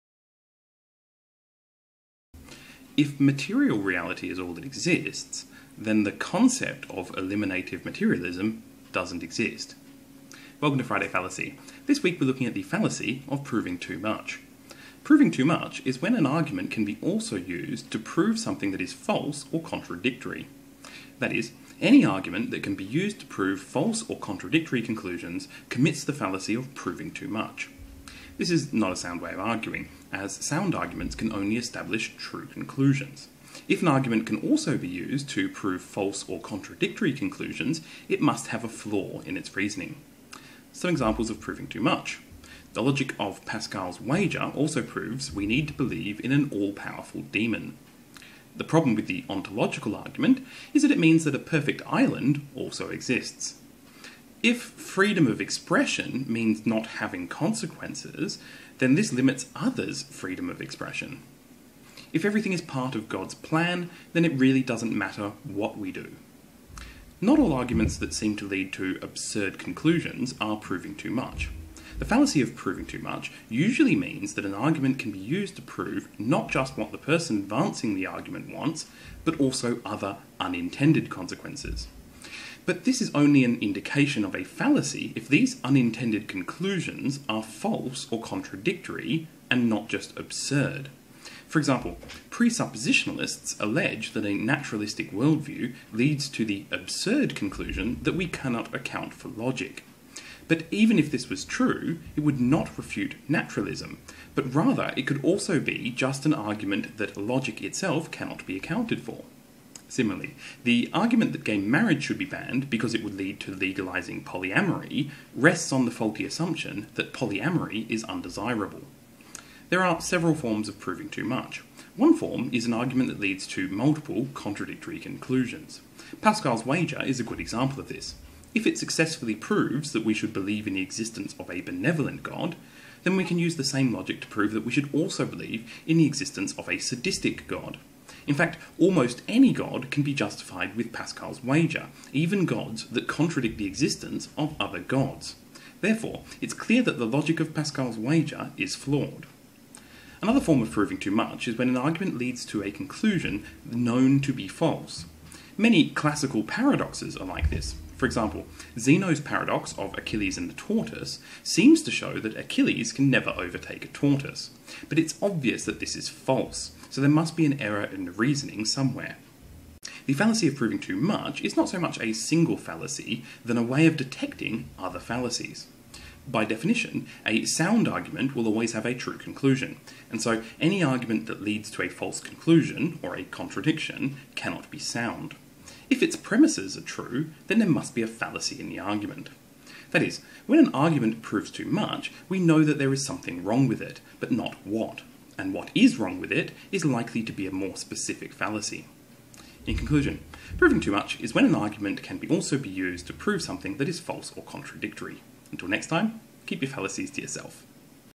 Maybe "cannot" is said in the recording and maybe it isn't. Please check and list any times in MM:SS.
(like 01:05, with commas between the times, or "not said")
01:38, 01:48, 03:04.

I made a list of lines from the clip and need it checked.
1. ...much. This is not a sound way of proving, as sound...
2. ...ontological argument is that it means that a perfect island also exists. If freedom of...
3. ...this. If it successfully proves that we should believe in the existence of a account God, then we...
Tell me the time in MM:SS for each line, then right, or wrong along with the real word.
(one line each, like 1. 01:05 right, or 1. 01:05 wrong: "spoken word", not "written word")
1. 00:27 wrong: "arguing", not "proving"
2. 00:49 right
3. 02:07 wrong: "benevolent", not "account".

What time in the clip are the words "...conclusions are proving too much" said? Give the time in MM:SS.
01:09.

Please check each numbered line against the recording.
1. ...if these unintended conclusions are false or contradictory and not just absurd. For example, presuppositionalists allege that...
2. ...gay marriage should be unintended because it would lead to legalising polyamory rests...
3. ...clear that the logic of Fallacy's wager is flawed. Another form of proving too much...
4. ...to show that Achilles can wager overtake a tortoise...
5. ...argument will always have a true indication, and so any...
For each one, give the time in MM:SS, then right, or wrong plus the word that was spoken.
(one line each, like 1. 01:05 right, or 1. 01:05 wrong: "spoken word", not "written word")
1. 01:25 right
2. 01:51 wrong: "banned", not "unintended"
3. 02:26 wrong: "Pascal", not "Fallacy"
4. 02:41 wrong: "never", not "wager"
5. 02:57 wrong: "conclusion", not "indication".